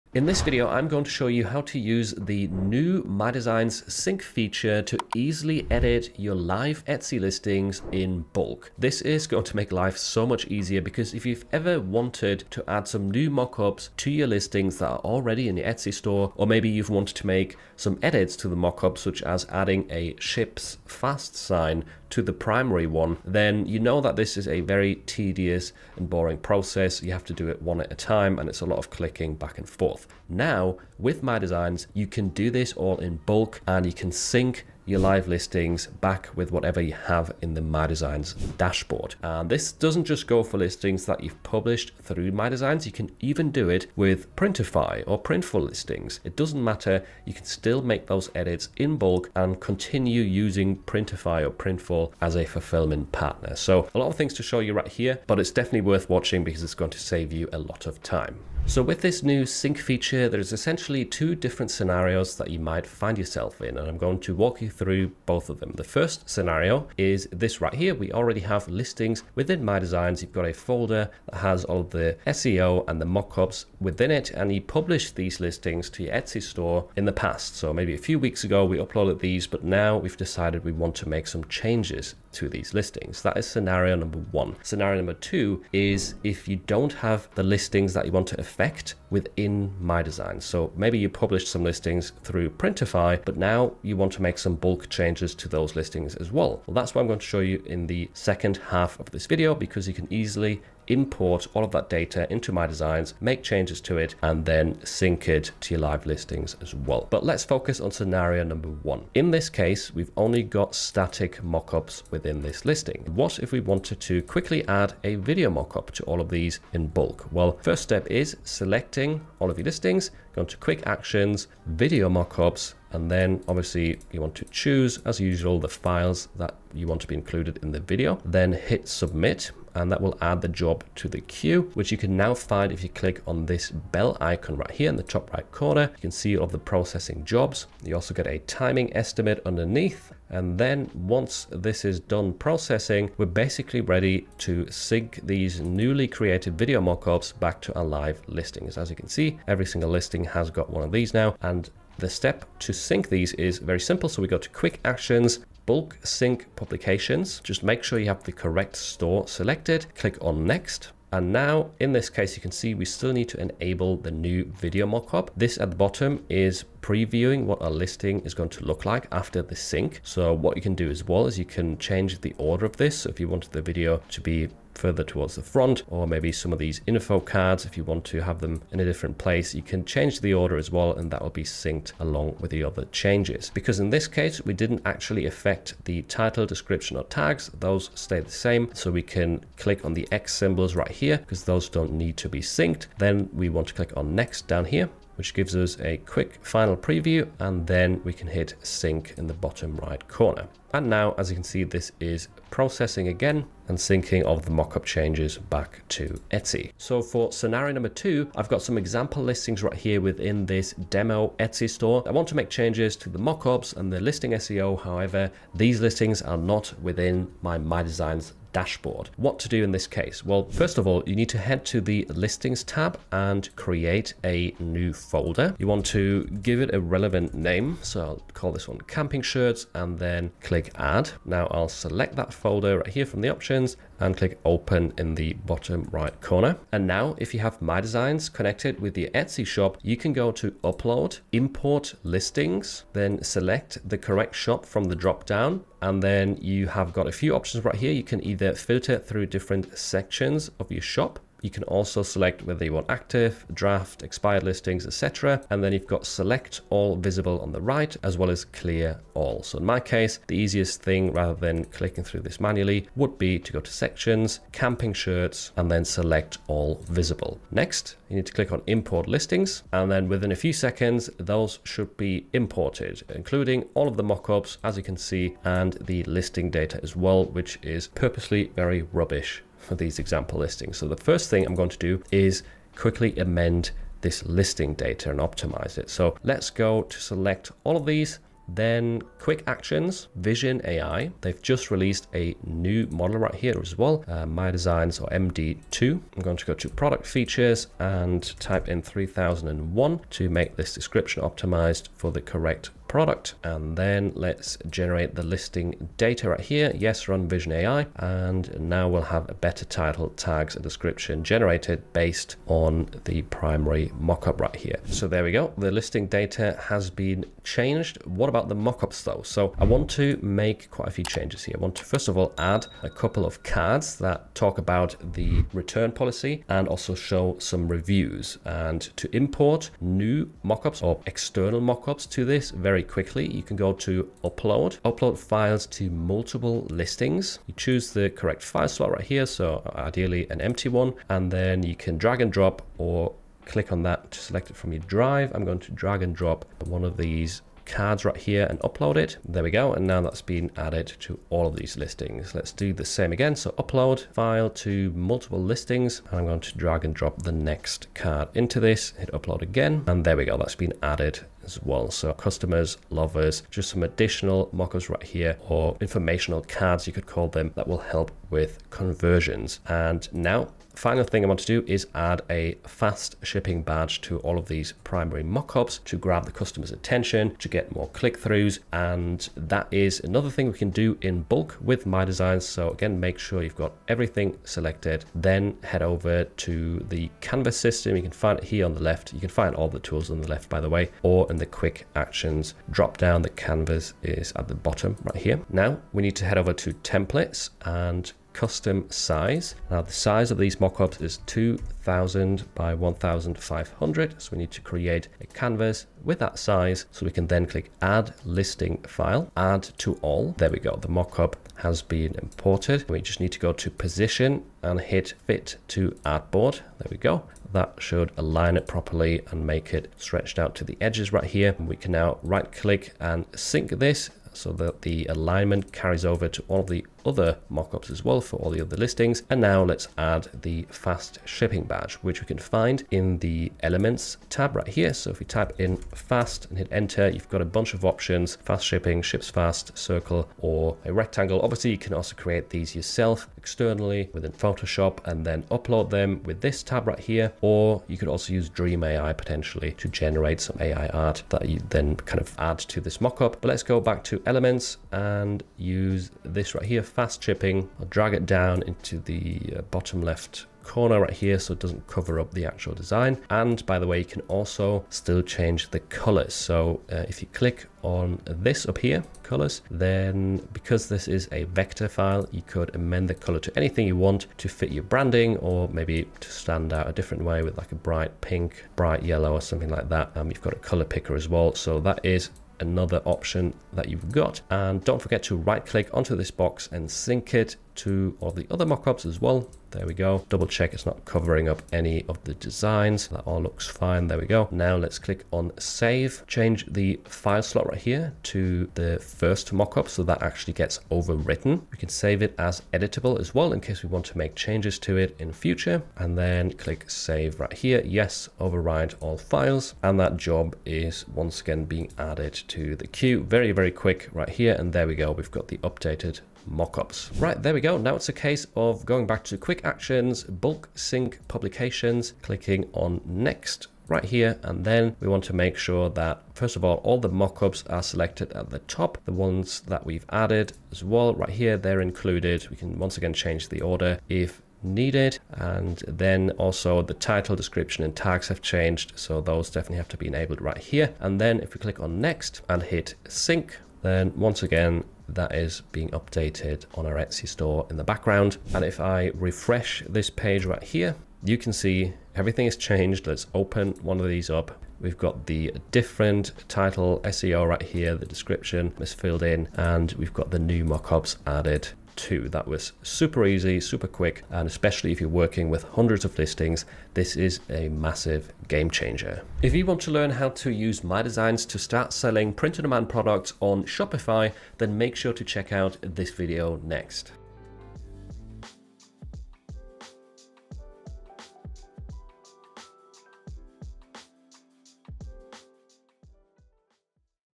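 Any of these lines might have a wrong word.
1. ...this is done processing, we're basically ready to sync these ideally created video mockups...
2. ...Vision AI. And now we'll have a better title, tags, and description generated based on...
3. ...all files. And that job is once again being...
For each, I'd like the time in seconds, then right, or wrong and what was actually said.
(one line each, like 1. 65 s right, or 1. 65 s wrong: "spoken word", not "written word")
1. 141 s wrong: "newly", not "ideally"
2. 307 s right
3. 508 s right.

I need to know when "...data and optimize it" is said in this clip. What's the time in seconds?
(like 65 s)
284 s.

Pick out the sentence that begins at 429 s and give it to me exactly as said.
And now let's add the fast shipping badge, which we can find in the elements tab right here.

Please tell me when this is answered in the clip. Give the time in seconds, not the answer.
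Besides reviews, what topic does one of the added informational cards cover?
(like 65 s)
325 s.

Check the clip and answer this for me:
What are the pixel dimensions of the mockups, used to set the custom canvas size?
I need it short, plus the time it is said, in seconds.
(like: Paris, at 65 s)
2000 by 1500, at 401 s.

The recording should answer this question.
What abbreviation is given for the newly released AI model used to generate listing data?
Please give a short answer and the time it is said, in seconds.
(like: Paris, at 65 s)
MD2, at 295 s.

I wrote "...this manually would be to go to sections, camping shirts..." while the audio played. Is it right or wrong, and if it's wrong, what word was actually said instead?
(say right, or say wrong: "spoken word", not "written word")
right.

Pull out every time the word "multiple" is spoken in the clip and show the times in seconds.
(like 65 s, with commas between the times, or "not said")
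335 s, 354 s.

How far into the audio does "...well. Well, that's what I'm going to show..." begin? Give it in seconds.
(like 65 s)
96 s.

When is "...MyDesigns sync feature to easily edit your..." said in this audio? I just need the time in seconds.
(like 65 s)
3 s.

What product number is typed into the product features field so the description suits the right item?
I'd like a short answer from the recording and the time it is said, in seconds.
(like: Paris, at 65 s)
3001, at 298 s.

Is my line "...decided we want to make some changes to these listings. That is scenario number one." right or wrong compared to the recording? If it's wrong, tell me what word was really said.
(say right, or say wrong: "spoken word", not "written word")
right.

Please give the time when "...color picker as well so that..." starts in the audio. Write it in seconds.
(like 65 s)
480 s.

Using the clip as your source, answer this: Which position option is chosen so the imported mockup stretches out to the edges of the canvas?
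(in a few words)
fit to artboard.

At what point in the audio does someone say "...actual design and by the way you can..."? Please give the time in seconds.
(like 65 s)
462 s.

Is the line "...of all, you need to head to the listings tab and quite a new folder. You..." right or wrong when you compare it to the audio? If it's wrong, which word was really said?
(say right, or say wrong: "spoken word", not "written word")
wrong: "create", not "quite".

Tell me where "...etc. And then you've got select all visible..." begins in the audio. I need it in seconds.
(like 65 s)
254 s.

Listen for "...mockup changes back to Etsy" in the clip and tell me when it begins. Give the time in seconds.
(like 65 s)
204 s.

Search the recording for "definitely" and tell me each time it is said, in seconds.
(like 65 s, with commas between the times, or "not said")
55 s, 539 s.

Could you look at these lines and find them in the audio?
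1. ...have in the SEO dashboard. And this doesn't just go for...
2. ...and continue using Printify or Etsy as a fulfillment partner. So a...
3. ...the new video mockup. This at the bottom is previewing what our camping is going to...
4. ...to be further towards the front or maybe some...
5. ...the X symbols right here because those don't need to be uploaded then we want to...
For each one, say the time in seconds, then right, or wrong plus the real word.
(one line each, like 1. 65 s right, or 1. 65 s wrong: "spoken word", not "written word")
1. 36 s wrong: "MyDesigns", not "SEO"
2. 49 s wrong: "Printful", not "Etsy"
3. 163 s wrong: "listing", not "camping"
4. 174 s right
5. 189 s wrong: "synced", not "uploaded".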